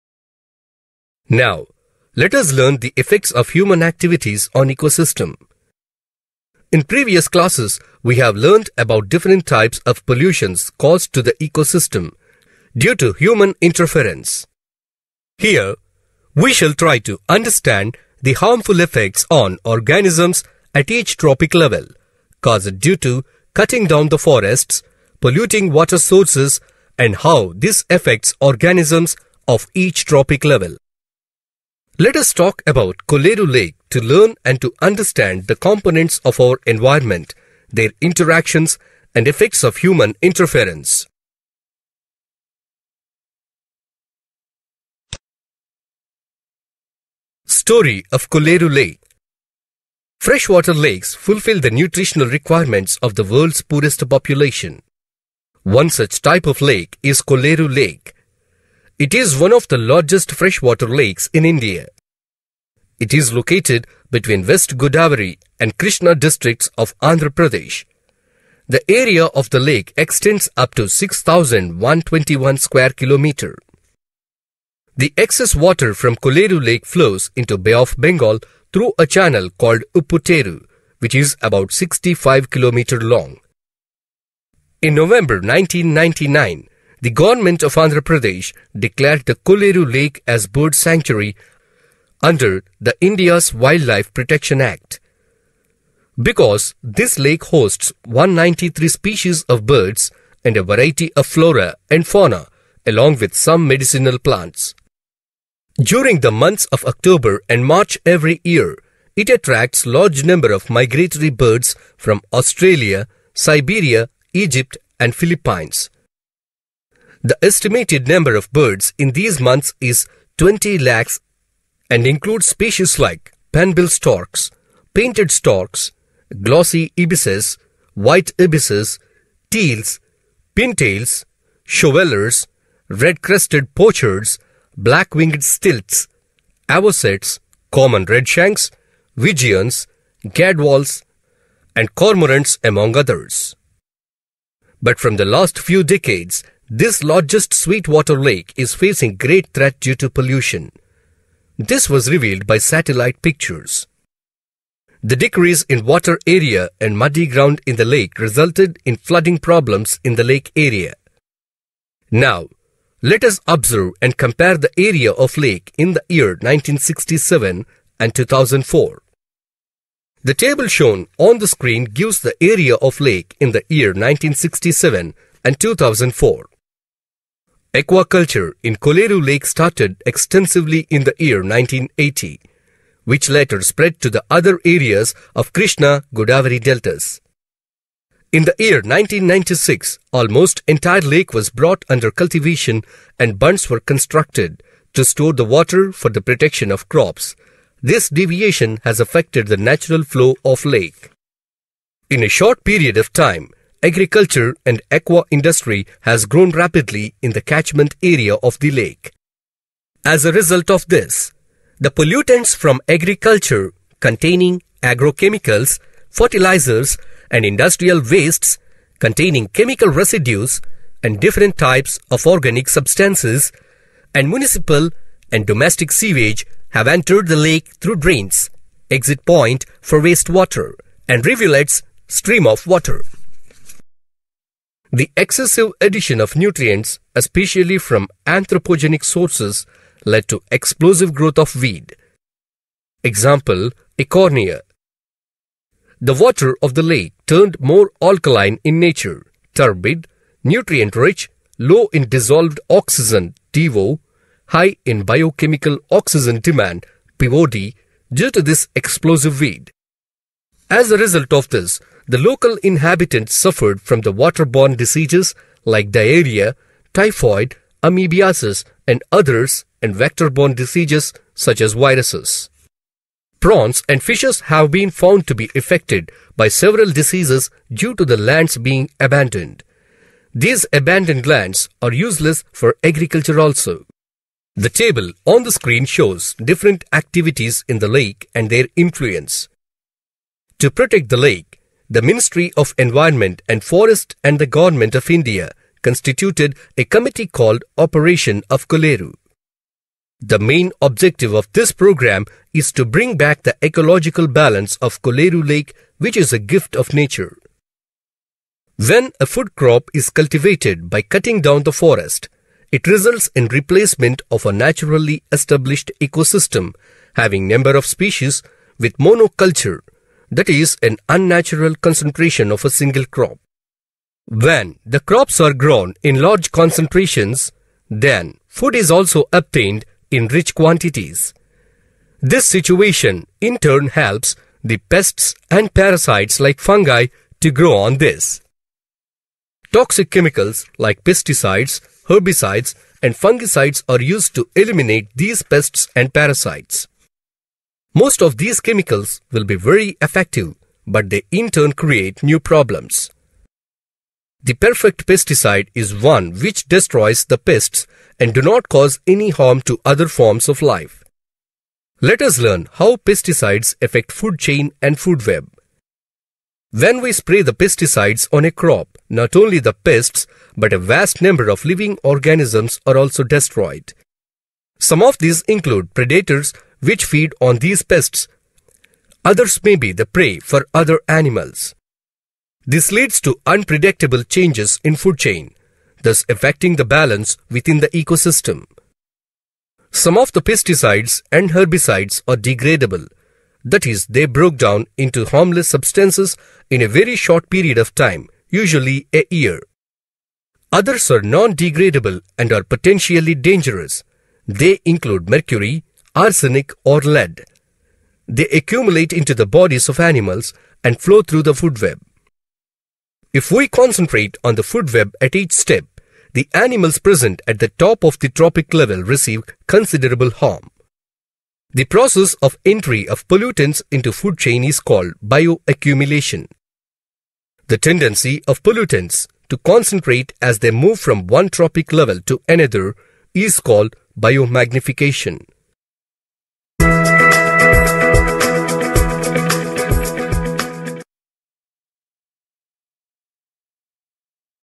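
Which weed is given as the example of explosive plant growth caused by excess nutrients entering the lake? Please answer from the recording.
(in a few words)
Eichhornia.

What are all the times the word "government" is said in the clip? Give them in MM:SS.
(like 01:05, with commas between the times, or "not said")
01:27, 04:54.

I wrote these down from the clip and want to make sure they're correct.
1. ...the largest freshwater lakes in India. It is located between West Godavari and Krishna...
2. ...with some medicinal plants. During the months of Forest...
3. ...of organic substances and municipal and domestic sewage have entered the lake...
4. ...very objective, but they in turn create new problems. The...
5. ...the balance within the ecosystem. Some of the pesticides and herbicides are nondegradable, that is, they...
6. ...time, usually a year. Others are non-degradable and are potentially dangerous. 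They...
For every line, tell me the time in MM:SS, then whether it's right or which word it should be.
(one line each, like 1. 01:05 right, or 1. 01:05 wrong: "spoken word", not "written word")
1. 00:59 right
2. 01:43 wrong: "October", not "Forest"
3. 03:42 right
4. 05:49 wrong: "effective", not "objective"
5. 06:26 wrong: "degradable", not "nondegradable"
6. 06:37 right.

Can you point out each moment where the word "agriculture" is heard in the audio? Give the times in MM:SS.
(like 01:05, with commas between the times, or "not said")
03:23, 03:32, 04:42.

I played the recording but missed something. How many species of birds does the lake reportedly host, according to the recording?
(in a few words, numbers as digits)
193.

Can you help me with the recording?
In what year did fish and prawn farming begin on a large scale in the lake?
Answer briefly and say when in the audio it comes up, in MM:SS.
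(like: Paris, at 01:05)
1980, at 03:01.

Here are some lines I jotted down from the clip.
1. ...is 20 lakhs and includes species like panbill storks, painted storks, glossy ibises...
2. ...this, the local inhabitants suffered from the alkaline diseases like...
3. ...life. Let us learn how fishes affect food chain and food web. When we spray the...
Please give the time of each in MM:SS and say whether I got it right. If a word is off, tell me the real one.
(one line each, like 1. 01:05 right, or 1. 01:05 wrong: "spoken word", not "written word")
1. 01:59 right
2. 04:21 wrong: "waterborne", not "alkaline"
3. 06:00 wrong: "pesticides", not "fishes".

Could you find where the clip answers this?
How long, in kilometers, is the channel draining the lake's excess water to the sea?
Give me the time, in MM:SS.
01:21.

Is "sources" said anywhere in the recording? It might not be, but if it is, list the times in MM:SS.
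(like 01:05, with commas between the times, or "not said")
00:25, 03:59.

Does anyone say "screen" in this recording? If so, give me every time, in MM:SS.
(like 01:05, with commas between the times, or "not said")
02:51, 04:45.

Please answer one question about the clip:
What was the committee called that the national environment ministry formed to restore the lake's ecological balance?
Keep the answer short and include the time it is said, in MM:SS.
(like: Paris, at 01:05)
Operation of Kolleru, at 04:57.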